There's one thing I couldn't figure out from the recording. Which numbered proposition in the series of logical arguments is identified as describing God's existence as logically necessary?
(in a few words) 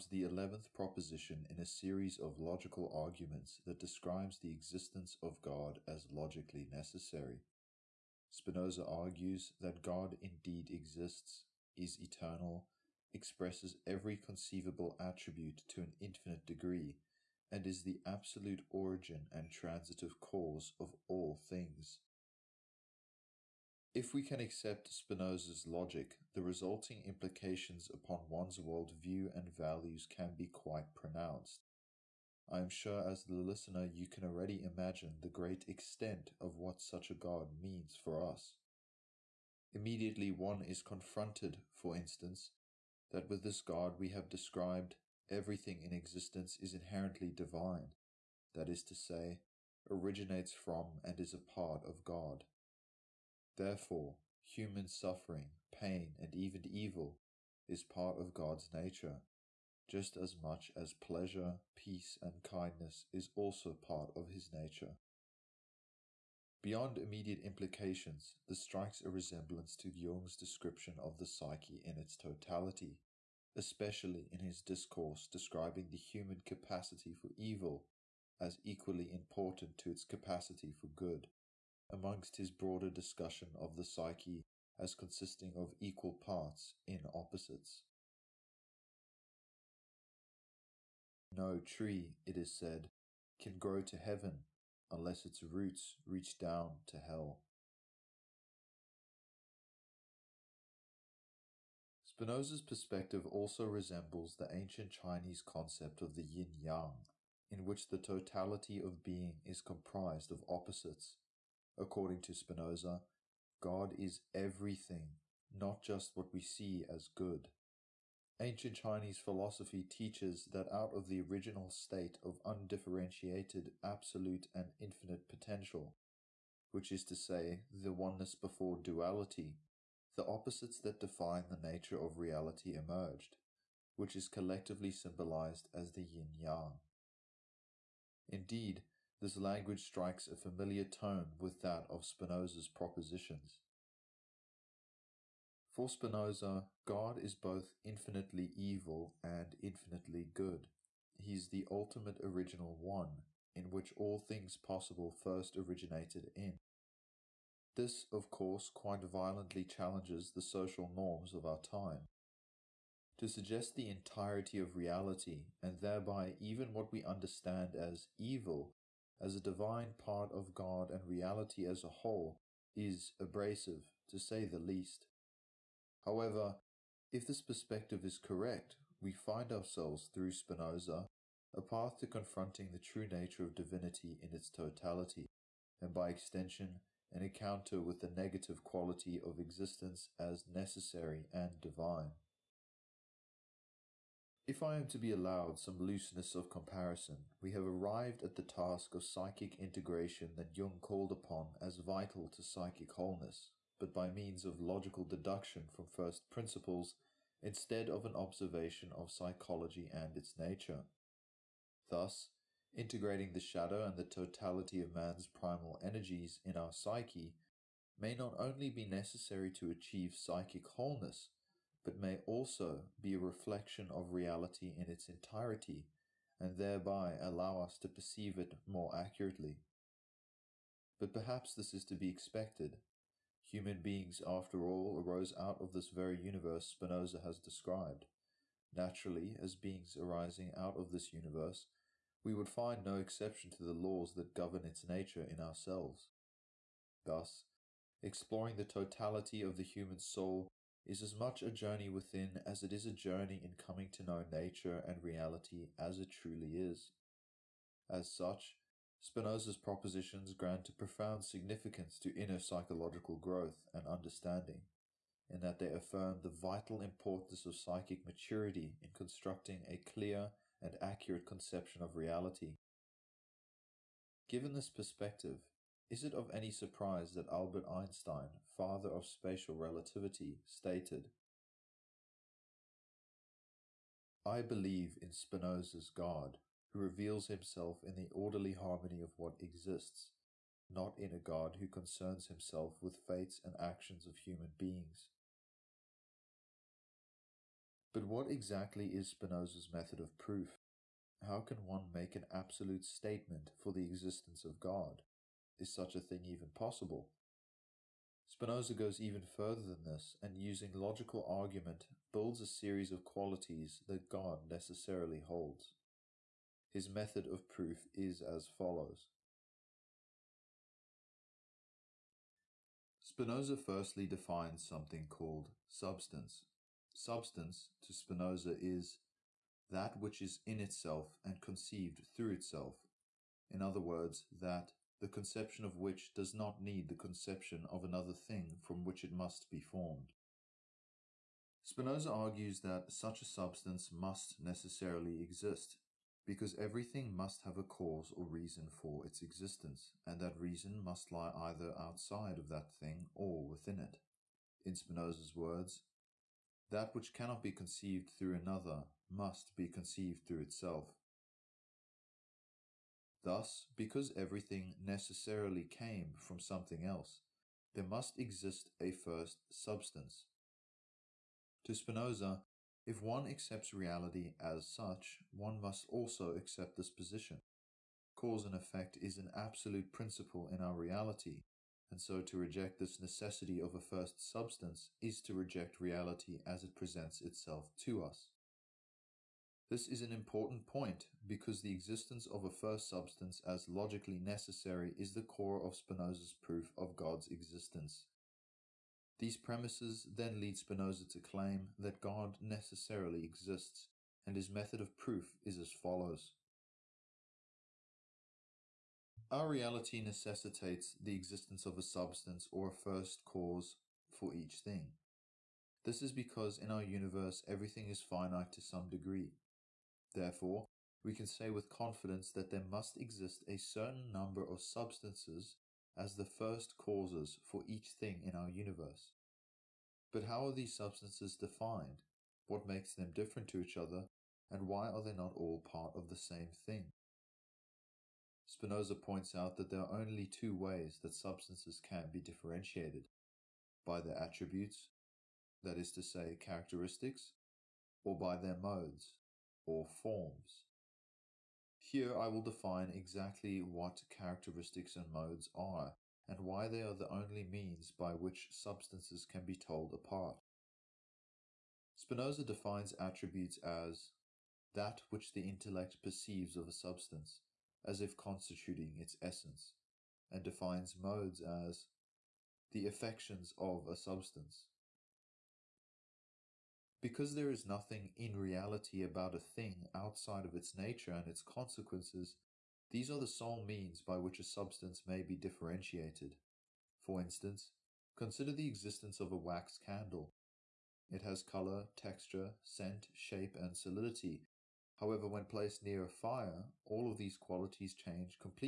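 eleventh.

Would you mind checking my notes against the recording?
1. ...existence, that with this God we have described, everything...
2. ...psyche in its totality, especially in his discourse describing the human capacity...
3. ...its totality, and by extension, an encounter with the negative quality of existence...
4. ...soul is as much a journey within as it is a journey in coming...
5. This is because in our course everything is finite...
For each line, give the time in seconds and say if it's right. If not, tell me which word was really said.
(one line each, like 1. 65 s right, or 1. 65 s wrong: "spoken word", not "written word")
1. 41 s wrong: "instance", not "existence"
2. 71 s right
3. 184 s right
4. 250 s right
5. 415 s wrong: "universe", not "course".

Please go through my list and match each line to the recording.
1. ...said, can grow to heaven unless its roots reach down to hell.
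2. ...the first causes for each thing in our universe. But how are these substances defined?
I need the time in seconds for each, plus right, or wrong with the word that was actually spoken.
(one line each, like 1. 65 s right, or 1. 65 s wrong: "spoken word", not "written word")
1. 92 s right
2. 426 s right.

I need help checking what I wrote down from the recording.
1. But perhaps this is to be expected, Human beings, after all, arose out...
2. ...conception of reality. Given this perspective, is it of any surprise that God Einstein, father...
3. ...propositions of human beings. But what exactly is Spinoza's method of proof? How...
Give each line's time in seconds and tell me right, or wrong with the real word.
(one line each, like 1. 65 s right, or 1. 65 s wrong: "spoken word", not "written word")
1. 230 s right
2. 271 s wrong: "Albert", not "God"
3. 293 s wrong: "actions", not "propositions".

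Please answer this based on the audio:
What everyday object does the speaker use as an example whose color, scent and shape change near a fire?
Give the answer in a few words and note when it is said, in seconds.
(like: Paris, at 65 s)
wax candle, at 489 s.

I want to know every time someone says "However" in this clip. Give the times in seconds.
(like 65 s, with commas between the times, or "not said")
176 s, 494 s.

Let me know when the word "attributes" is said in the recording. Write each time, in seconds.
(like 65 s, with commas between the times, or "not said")
14 s, 444 s, 462 s.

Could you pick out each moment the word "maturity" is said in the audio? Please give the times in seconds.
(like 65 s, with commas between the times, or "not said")
268 s.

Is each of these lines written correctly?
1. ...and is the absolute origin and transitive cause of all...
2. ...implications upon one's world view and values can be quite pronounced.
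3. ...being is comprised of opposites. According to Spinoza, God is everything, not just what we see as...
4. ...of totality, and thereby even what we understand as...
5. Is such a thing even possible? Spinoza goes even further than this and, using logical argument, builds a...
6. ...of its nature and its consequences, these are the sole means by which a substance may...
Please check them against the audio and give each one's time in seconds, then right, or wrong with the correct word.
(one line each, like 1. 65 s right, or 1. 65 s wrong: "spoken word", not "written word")
1. 17 s right
2. 27 s right
3. 109 s right
4. 164 s wrong: "reality", not "totality"
5. 305 s right
6. 480 s right.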